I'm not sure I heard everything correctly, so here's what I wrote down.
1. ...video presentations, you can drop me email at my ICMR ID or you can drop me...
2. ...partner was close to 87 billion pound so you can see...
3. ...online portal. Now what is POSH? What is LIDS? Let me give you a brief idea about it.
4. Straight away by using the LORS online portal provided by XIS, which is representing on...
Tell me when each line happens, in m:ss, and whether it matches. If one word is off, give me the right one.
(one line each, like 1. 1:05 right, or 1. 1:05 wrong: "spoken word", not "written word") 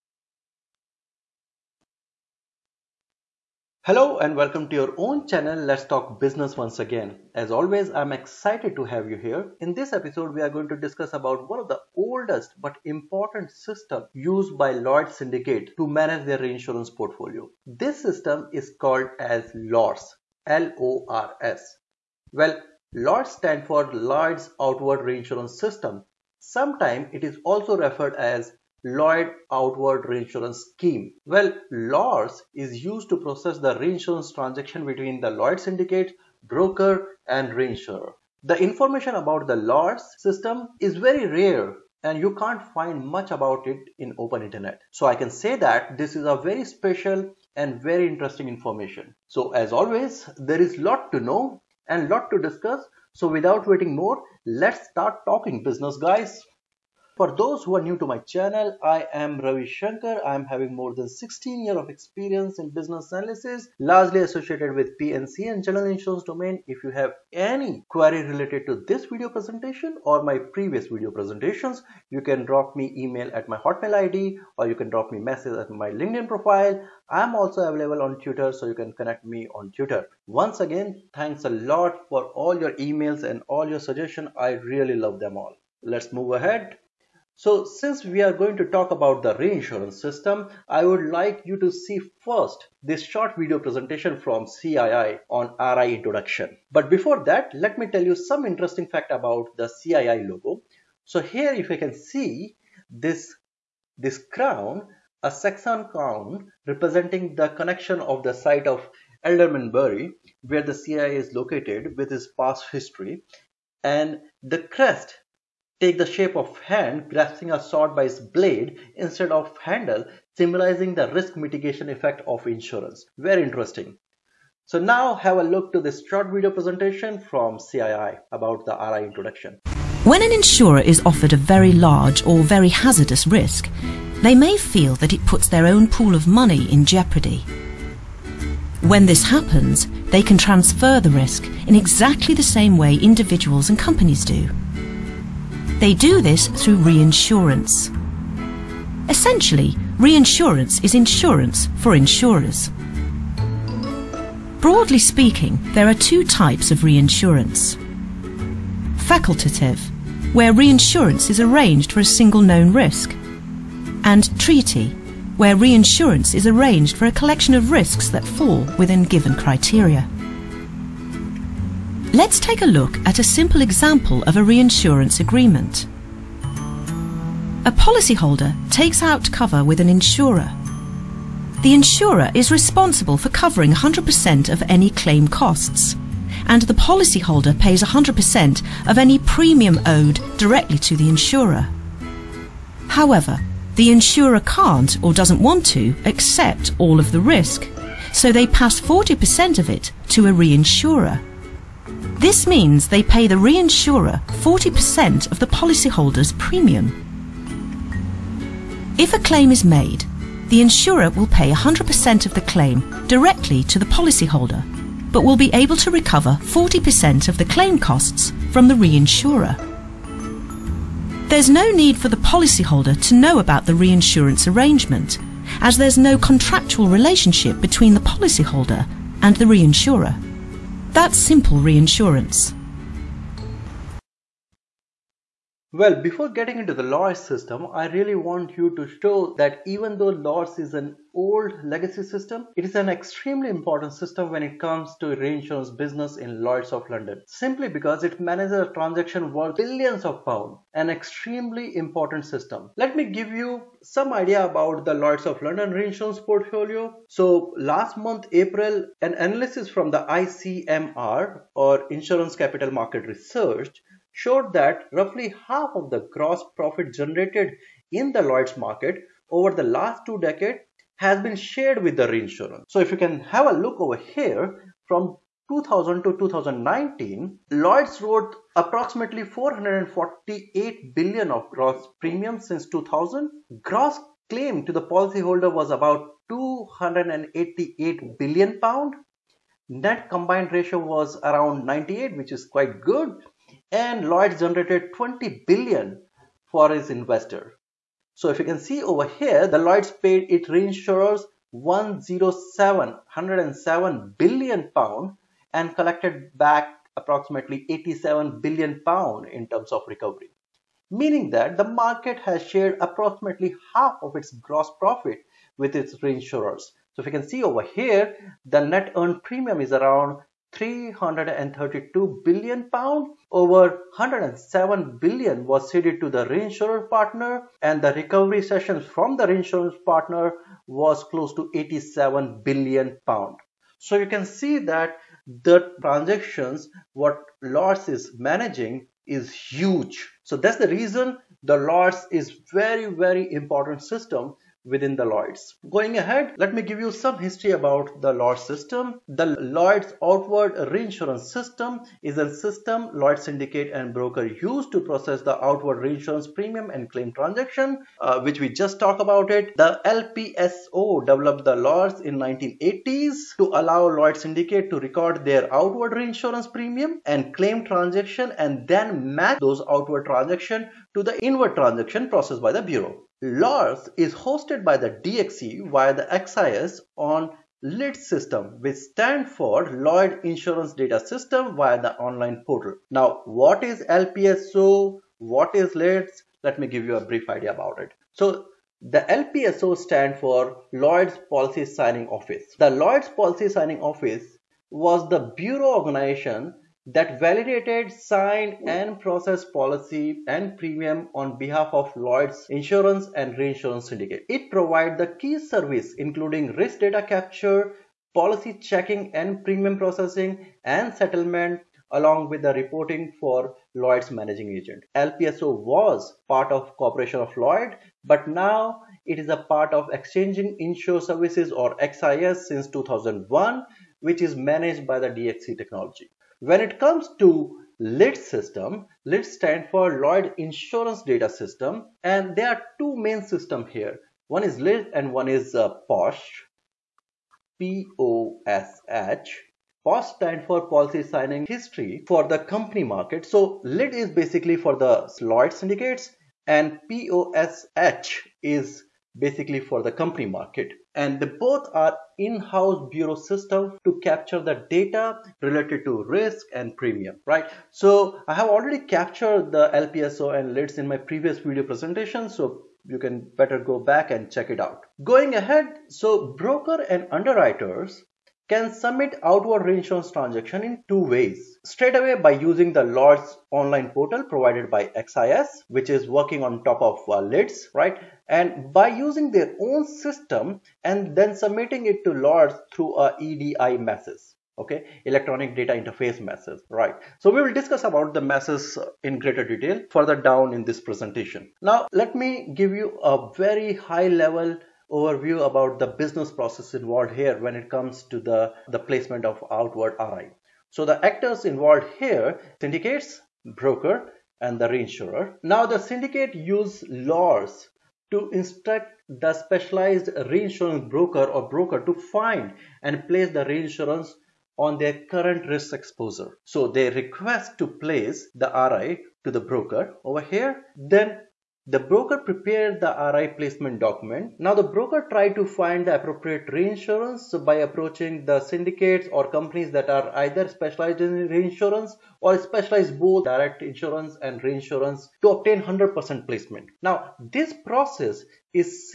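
1. 1:10 wrong: "Hotmail", not "ICMR"
2. 5:29 right
3. 6:21 wrong: "LPSO", not "POSH"
4. 7:51 wrong: "working", not "representing".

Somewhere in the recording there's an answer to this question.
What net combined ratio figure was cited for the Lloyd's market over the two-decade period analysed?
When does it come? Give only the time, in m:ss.
4:51.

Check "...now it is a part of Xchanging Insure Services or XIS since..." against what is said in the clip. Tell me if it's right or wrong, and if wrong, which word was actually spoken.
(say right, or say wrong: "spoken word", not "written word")
right.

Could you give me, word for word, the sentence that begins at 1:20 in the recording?
Once again, thanks a lot for all your emails and all your suggestions.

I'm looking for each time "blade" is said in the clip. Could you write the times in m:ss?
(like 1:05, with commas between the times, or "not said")
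1:58.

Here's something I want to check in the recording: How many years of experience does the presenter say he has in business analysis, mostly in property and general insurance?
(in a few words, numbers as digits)
16.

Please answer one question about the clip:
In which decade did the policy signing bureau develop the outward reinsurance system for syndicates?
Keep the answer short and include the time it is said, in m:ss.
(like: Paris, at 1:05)
1980s, at 6:02.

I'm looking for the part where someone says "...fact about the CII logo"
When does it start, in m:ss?
1:38.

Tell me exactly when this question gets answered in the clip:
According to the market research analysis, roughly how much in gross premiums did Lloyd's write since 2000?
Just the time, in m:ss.
4:39.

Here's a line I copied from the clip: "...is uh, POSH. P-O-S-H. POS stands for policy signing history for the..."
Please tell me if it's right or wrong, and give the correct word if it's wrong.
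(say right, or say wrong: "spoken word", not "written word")
right.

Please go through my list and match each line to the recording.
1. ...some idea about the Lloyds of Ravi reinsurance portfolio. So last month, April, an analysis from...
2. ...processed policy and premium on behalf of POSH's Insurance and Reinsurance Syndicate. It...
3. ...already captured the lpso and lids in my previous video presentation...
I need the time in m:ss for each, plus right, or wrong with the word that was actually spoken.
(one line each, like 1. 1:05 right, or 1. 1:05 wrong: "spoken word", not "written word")
1. 4:13 wrong: "London", not "Ravi"
2. 6:39 wrong: "Lloyd", not "POSH"
3. 7:38 right.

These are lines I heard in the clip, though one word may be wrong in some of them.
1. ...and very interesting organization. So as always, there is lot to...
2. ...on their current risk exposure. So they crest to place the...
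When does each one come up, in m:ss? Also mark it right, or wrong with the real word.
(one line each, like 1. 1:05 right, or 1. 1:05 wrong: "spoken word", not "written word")
1. 0:47 wrong: "information", not "organization"
2. 8:34 wrong: "request", not "crest".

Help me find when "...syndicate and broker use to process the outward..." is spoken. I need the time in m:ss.
5:53.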